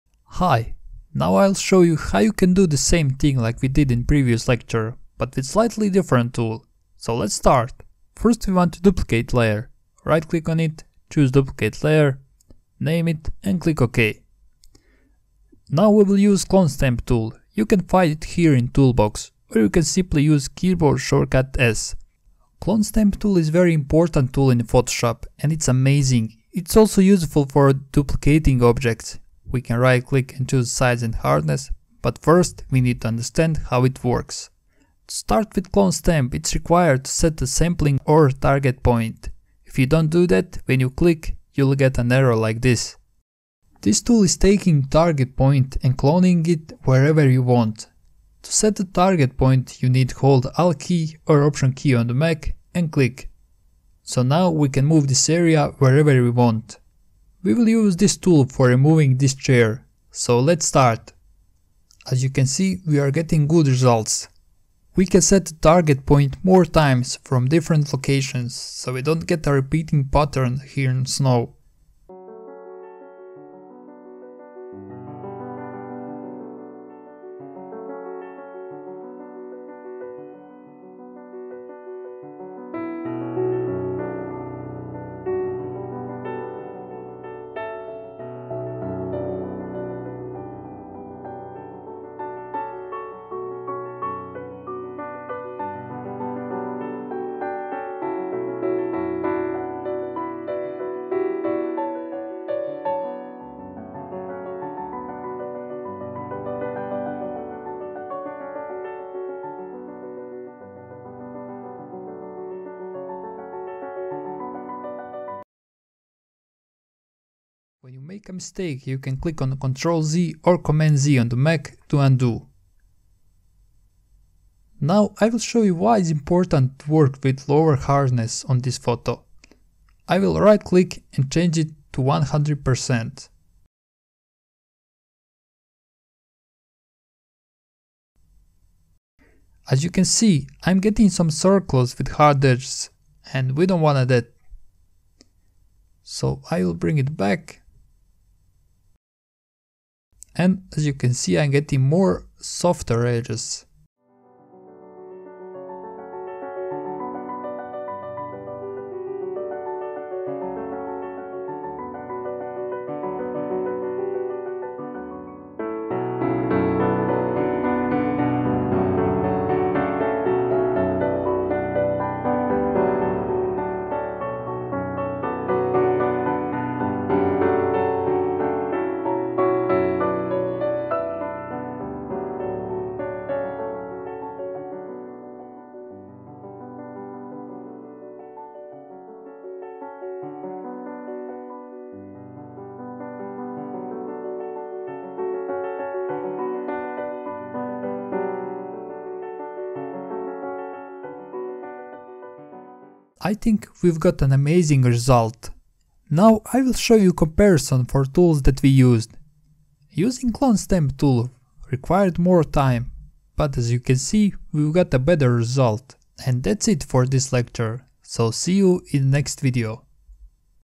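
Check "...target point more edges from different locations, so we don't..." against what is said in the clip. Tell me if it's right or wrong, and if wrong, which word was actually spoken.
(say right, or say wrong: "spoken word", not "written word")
wrong: "times", not "edges".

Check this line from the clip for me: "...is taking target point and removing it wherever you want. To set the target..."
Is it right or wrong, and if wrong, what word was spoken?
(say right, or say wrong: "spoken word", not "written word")
wrong: "cloning", not "removing".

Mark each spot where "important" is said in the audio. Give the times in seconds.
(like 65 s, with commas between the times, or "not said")
23 s, 126 s.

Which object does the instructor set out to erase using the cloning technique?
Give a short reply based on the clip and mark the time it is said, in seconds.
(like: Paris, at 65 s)
chair, at 59 s.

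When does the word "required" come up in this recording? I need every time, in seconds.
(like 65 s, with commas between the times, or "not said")
36 s, 211 s.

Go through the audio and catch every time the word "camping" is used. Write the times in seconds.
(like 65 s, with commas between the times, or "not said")
not said.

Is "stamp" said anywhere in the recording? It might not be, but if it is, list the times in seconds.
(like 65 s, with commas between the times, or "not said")
16 s, 22 s, 35 s, 210 s.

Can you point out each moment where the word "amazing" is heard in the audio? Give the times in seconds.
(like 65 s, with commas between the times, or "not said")
25 s, 204 s.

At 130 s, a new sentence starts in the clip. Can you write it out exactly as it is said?
I will right click and change it to 100%.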